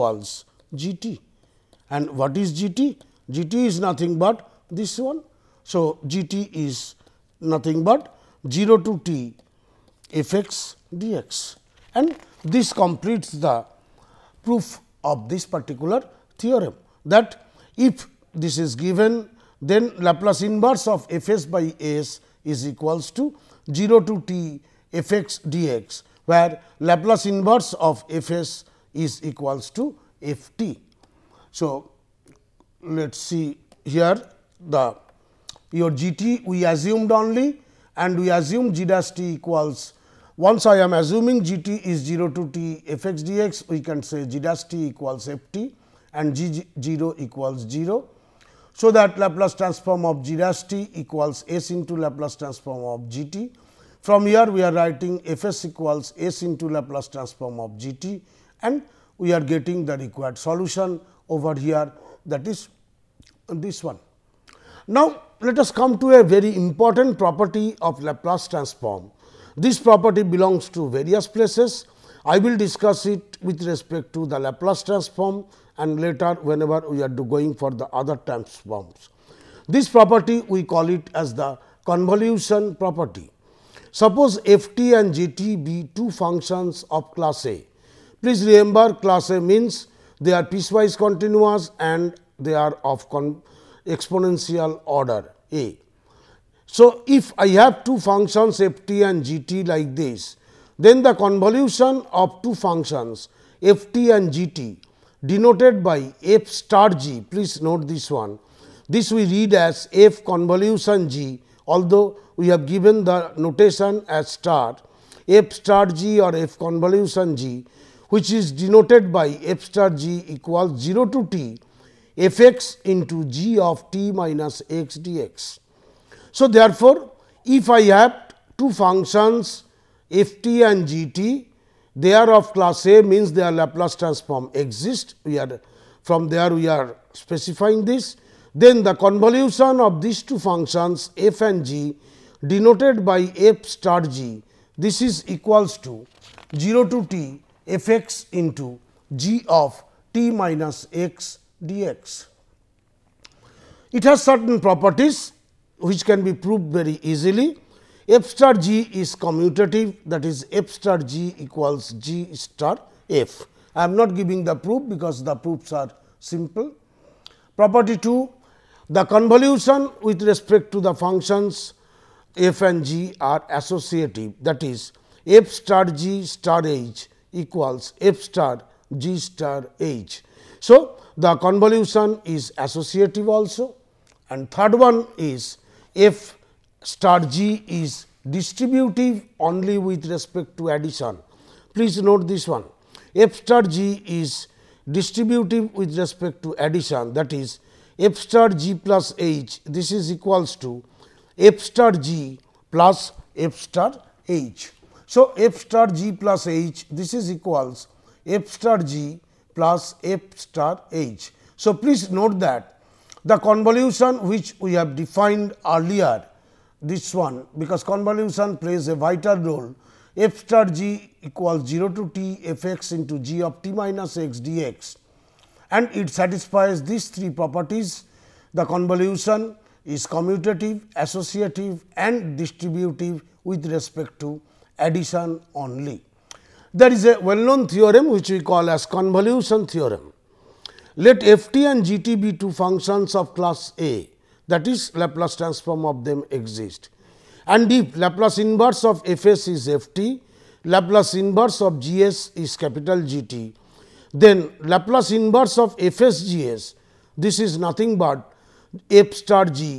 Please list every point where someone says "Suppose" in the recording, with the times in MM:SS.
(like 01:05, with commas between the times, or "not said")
01:23.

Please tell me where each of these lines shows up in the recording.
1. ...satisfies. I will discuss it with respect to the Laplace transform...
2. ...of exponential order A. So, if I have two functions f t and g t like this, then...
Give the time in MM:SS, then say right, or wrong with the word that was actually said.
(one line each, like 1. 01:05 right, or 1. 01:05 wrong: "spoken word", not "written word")
1. 01:11 wrong: "places", not "satisfies"
2. 01:32 right.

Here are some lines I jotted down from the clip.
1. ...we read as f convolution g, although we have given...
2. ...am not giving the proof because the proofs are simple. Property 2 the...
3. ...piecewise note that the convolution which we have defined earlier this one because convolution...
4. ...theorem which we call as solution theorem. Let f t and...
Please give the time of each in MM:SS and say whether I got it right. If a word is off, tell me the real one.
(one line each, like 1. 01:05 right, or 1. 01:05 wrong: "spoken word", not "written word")
1. 01:49 right
2. 02:43 right
3. 03:31 wrong: "please", not "piecewise"
4. 03:57 wrong: "convolution", not "solution".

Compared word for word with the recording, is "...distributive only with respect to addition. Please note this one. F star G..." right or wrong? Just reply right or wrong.
right.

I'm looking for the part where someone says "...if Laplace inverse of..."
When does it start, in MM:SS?
04:07.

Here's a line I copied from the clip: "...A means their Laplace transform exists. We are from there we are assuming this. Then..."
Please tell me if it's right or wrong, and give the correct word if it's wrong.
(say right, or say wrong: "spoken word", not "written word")
wrong: "specifying", not "assuming".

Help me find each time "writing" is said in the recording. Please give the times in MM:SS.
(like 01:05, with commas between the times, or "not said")
00:54.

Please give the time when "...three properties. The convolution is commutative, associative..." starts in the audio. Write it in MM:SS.
03:47.